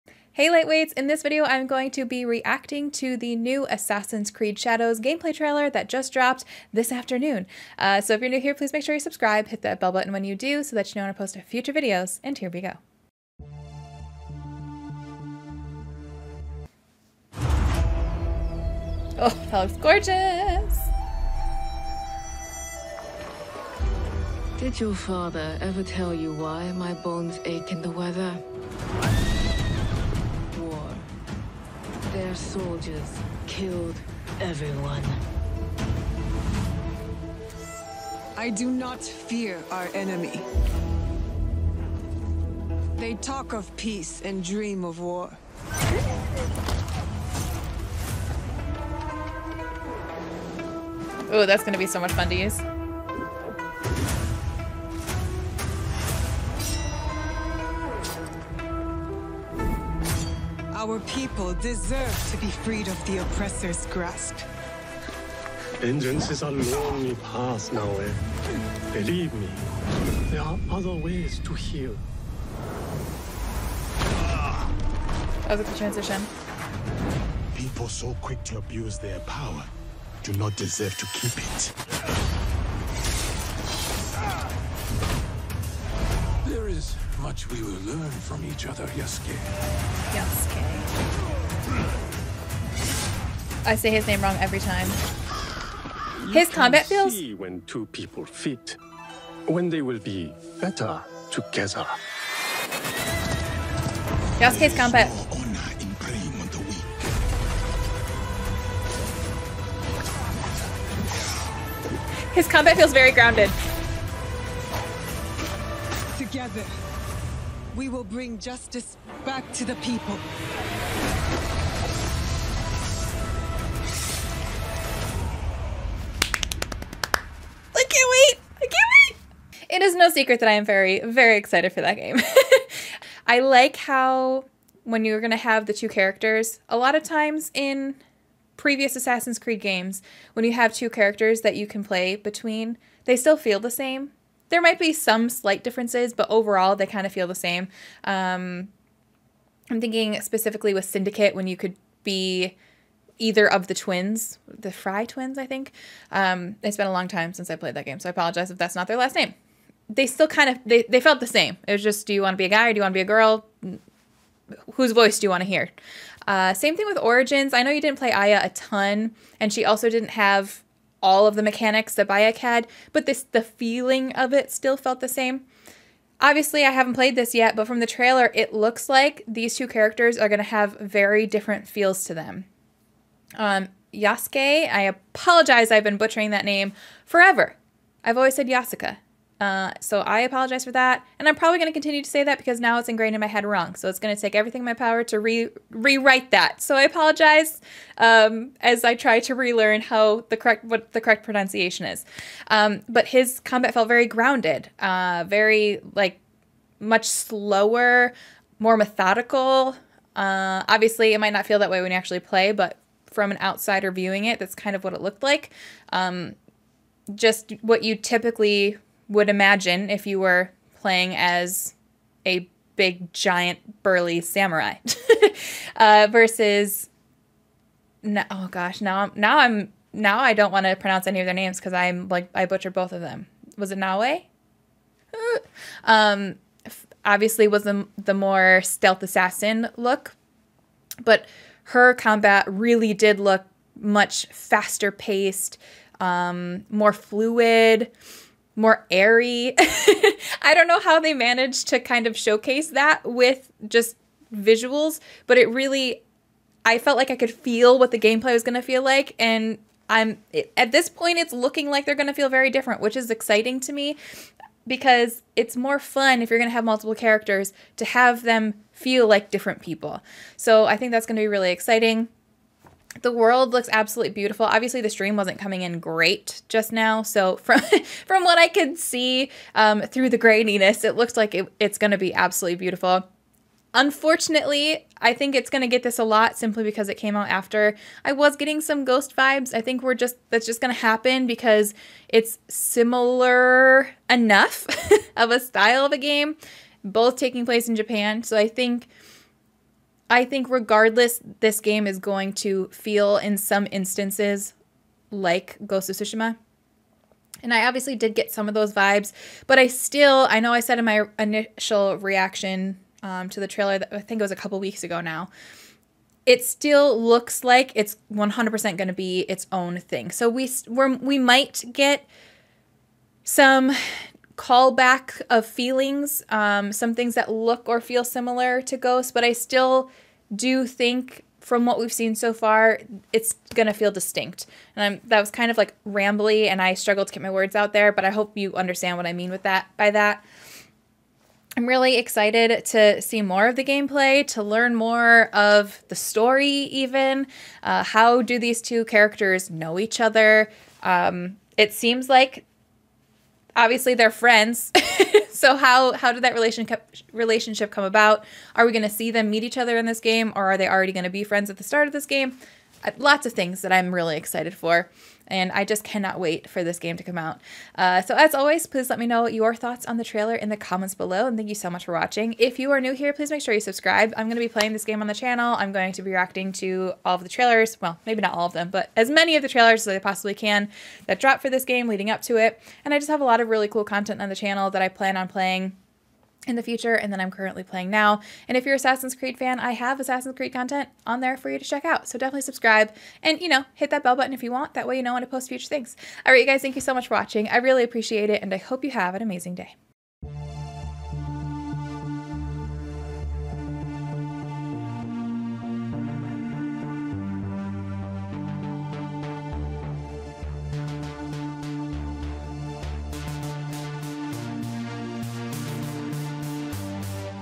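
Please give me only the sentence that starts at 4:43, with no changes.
Unfortunately, I think it's going to get this a lot simply because it came out after.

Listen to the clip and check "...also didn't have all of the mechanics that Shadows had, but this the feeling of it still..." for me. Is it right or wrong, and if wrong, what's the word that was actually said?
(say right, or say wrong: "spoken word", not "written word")
wrong: "Bayek", not "Shadows".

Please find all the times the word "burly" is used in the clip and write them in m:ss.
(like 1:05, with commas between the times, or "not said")
3:43.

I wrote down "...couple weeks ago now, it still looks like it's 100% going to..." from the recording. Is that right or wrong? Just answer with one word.
right.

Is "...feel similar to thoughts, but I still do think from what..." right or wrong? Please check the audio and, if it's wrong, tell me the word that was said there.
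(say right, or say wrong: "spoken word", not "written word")
wrong: "ghosts", not "thoughts".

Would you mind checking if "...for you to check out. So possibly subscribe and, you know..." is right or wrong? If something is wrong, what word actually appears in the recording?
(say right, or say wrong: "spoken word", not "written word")
wrong: "definitely", not "possibly".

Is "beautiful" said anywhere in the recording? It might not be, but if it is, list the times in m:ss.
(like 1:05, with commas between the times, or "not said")
4:34, 4:42.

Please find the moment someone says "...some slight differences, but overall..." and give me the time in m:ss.
2:24.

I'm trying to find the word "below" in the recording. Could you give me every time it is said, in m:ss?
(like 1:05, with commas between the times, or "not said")
6:10.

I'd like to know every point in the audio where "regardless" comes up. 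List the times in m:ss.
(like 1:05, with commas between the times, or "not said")
5:00.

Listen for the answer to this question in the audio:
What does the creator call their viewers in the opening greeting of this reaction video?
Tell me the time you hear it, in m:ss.
0:00.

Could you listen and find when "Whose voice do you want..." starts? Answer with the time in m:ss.
2:44.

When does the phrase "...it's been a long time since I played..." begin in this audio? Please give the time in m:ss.
2:36.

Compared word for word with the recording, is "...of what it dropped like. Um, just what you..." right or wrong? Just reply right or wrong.
wrong.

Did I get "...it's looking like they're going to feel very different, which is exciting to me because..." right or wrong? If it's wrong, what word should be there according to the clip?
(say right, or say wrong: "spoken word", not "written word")
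right.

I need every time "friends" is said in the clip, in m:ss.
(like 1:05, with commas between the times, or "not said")
5:54, 6:01.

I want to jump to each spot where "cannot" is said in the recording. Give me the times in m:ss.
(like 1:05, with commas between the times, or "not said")
6:05.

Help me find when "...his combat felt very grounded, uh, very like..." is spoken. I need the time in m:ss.
3:23.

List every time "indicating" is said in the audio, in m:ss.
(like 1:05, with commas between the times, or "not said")
not said.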